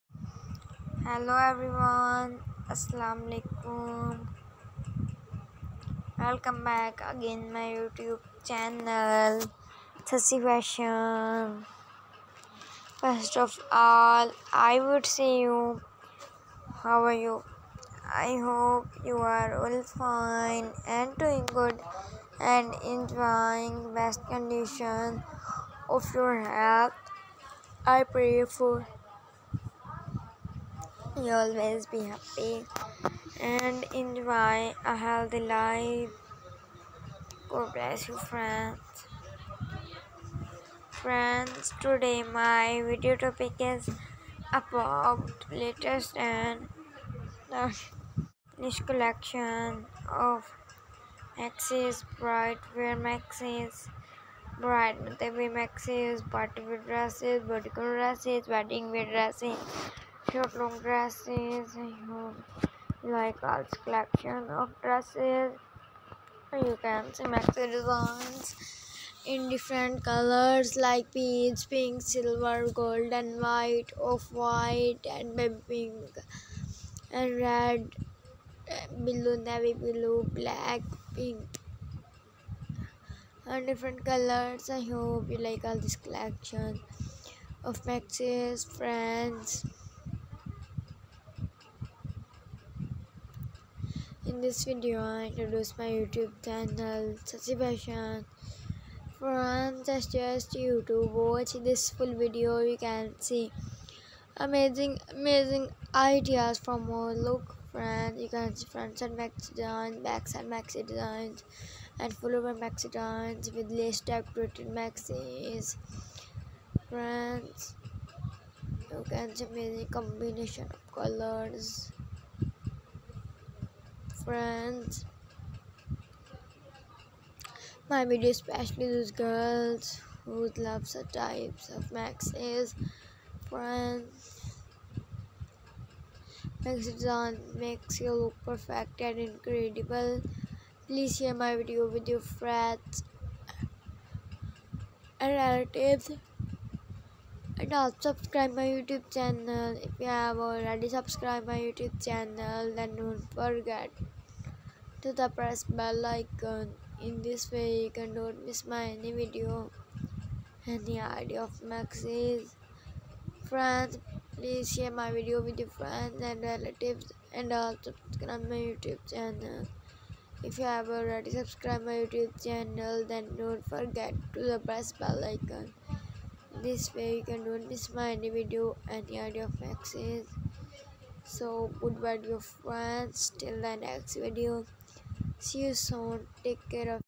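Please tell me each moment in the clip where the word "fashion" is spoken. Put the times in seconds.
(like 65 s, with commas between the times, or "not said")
10 s, 97 s.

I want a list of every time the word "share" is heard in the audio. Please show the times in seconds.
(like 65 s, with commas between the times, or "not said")
141 s, 164 s.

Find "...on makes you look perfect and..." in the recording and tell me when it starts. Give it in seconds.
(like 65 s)
137 s.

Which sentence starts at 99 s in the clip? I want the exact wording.
Friends, just just YouTube, watch this full video.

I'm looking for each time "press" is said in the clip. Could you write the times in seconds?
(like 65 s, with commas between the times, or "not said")
155 s, 174 s.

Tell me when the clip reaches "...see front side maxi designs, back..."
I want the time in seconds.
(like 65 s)
108 s.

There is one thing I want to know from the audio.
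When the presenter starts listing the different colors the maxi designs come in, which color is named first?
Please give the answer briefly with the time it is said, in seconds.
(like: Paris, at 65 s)
peach, at 71 s.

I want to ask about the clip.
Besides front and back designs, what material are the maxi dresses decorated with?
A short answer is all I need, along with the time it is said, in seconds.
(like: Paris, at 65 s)
lace, at 113 s.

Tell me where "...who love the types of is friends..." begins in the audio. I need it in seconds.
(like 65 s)
130 s.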